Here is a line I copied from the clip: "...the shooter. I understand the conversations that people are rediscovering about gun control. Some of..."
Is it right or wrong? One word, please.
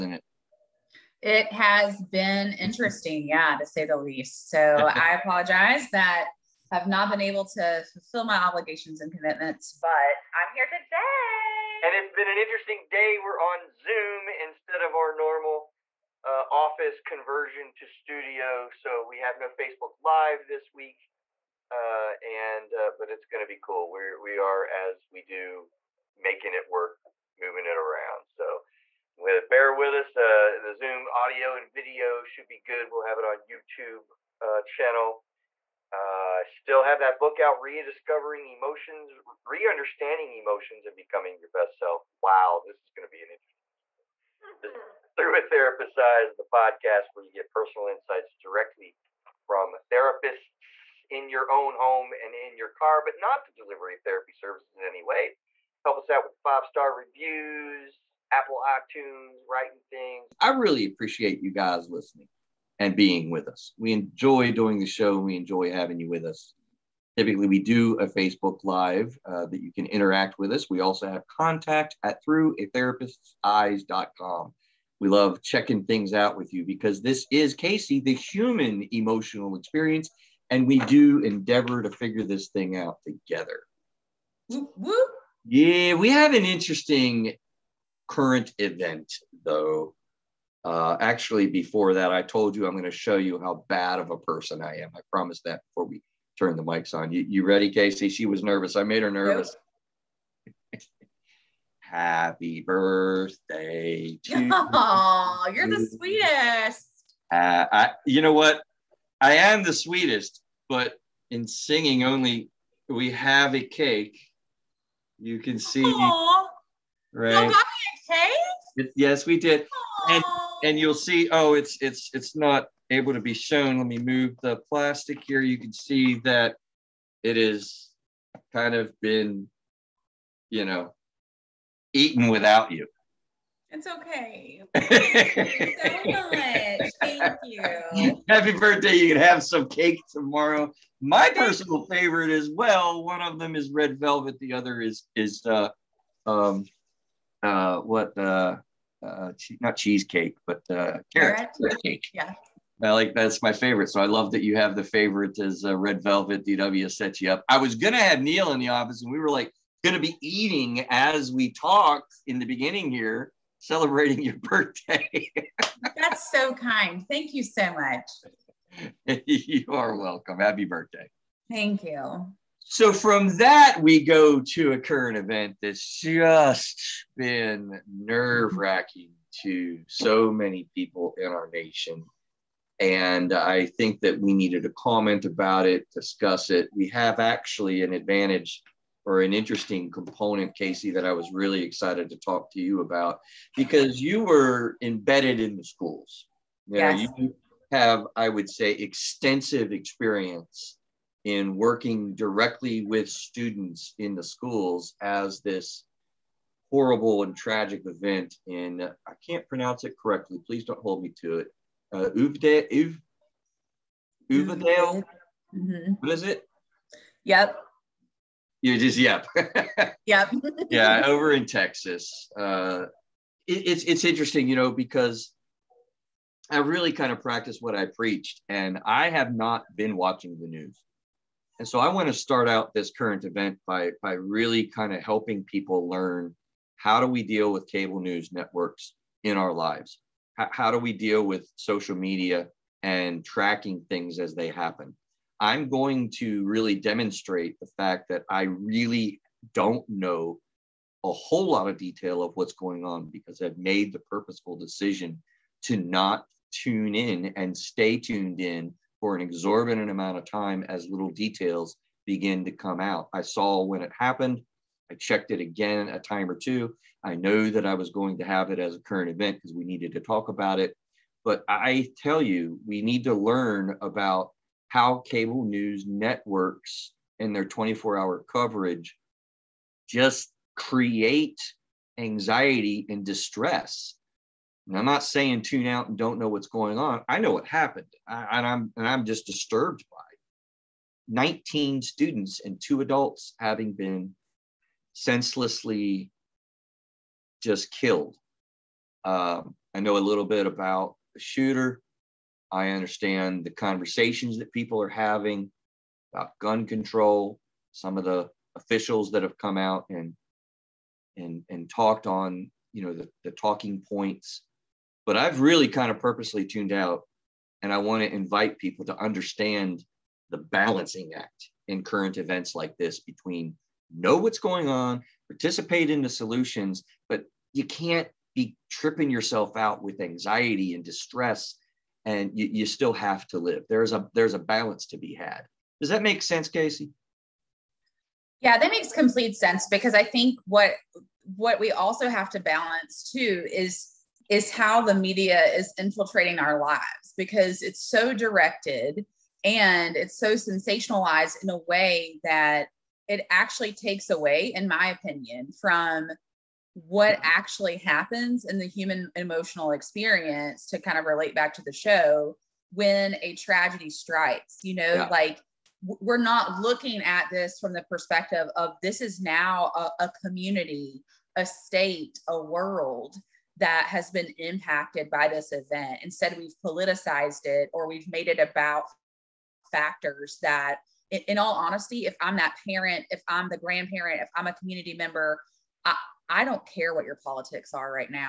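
wrong.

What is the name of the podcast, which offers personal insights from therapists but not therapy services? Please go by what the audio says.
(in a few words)
Through a Therapist's Eyes.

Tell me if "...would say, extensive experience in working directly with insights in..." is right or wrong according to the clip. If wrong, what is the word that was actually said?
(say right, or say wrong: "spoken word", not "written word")
wrong: "students", not "insights".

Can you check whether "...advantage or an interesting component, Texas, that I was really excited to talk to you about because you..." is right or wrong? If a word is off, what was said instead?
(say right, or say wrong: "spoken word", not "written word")
wrong: "Casey", not "Texas".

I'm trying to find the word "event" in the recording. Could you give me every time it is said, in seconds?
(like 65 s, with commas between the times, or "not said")
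88 s, 175 s, 207 s, 233 s, 269 s, 322 s, 375 s.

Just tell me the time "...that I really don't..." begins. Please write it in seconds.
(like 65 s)
248 s.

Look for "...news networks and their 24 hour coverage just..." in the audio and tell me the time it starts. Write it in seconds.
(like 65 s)
275 s.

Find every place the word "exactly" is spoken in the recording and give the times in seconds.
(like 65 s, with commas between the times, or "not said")
not said.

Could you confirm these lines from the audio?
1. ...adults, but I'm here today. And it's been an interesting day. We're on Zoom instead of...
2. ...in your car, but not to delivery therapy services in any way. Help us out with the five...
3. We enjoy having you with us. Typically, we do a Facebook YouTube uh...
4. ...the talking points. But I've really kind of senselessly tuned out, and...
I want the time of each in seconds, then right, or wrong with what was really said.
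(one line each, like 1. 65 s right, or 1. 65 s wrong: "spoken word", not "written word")
1. 9 s wrong: "commitments", not "adults"
2. 52 s right
3. 65 s wrong: "Live", not "YouTube"
4. 313 s wrong: "purposely", not "senselessly".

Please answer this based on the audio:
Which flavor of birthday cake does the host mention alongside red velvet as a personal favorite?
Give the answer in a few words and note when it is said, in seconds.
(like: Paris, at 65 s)
Carrot cake, at 151 s.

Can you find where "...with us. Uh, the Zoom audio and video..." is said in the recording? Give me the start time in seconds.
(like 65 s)
29 s.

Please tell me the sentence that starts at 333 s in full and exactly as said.
There's a there's a balance to be had.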